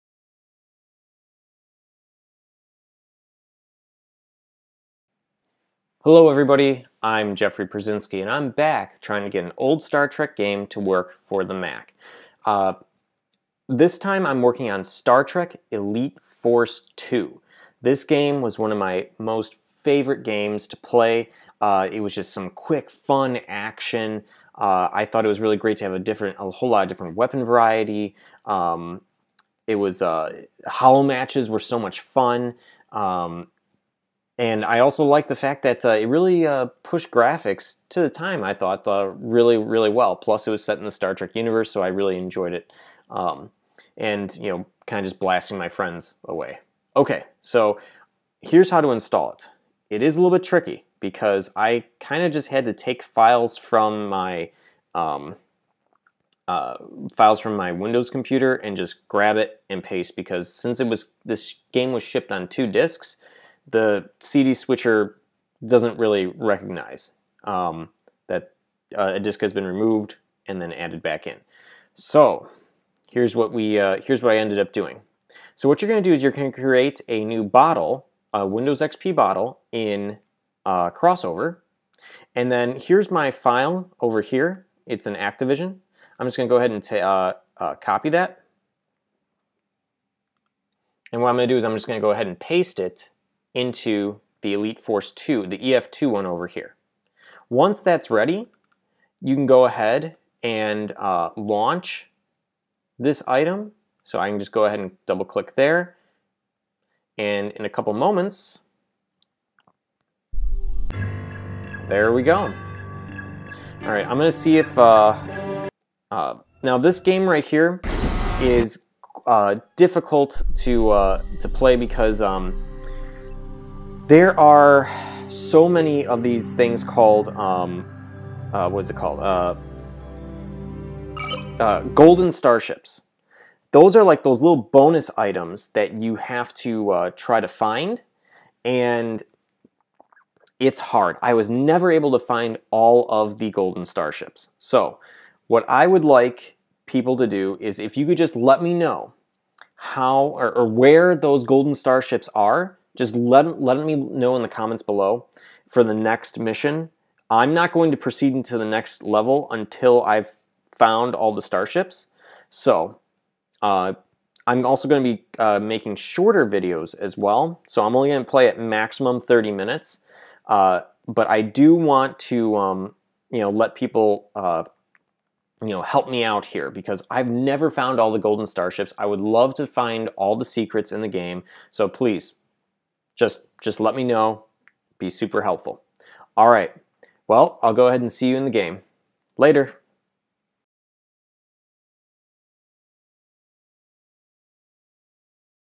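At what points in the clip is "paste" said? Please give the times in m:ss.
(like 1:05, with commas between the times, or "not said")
0:59, 1:32.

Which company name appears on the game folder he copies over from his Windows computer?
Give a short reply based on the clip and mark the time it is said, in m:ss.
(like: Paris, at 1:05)
Activision, at 1:25.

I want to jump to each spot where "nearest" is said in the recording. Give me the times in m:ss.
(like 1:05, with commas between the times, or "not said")
not said.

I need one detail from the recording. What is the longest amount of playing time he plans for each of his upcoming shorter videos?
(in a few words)
30 minutes.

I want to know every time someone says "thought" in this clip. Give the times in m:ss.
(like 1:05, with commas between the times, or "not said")
0:25, 0:38.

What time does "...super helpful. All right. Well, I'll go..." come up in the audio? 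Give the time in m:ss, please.
3:05.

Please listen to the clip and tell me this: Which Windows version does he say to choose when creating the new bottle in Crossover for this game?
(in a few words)
Windows XP.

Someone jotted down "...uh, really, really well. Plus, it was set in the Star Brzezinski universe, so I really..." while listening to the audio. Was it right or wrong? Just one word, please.
wrong.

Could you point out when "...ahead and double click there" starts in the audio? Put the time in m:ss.
1:44.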